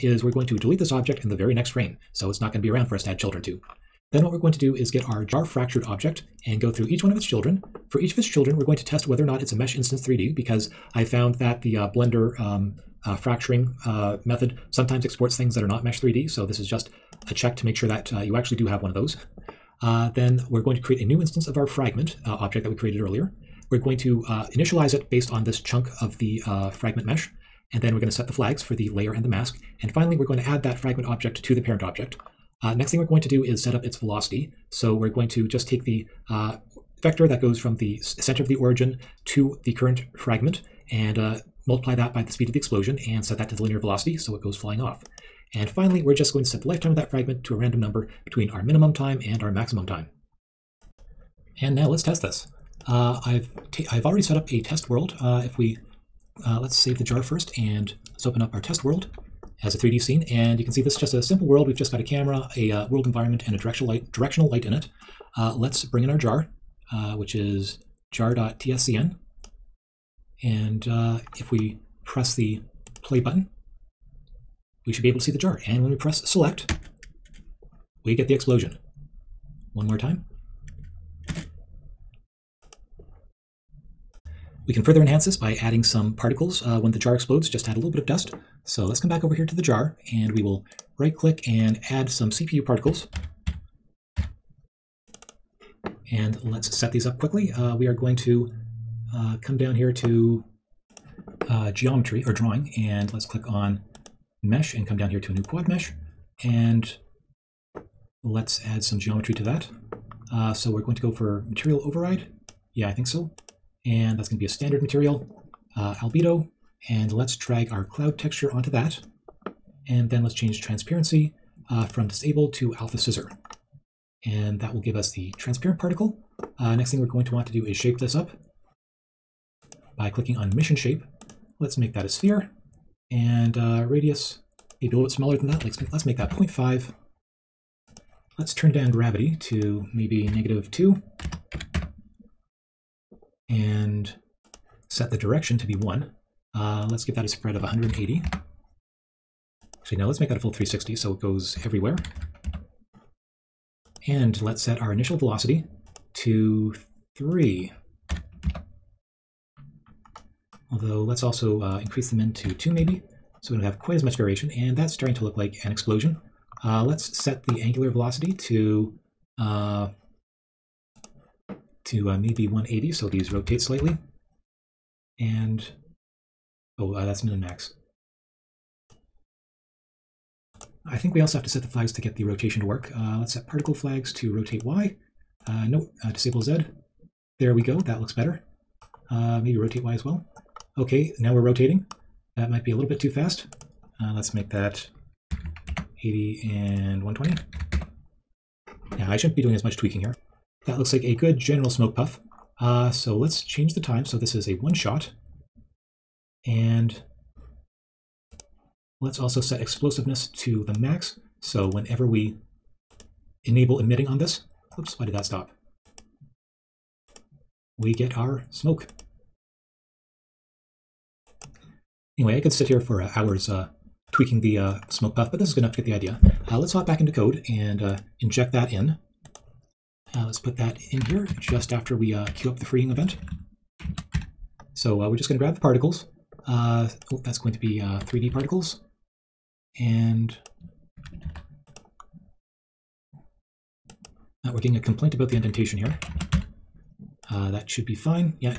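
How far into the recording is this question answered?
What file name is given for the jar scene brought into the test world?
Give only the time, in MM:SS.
01:08.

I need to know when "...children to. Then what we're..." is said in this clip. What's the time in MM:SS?
00:03.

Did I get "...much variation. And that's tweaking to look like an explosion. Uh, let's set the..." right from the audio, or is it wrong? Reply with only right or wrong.
wrong.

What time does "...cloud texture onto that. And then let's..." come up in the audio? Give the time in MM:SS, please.
01:57.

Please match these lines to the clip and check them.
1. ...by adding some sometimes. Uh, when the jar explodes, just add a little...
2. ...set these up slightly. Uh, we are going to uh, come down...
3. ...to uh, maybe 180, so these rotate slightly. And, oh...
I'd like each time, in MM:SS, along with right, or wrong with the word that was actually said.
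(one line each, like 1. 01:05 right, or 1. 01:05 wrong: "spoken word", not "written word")
1. 01:25 wrong: "particles", not "sometimes"
2. 01:36 wrong: "quickly", not "slightly"
3. 02:51 right.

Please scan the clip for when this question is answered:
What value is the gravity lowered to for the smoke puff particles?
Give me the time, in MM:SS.
02:20.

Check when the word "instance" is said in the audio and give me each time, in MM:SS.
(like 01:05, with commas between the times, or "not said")
00:09, 00:21.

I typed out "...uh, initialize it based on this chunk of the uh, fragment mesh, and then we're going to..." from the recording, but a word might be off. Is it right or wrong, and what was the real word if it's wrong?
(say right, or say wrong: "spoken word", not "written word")
right.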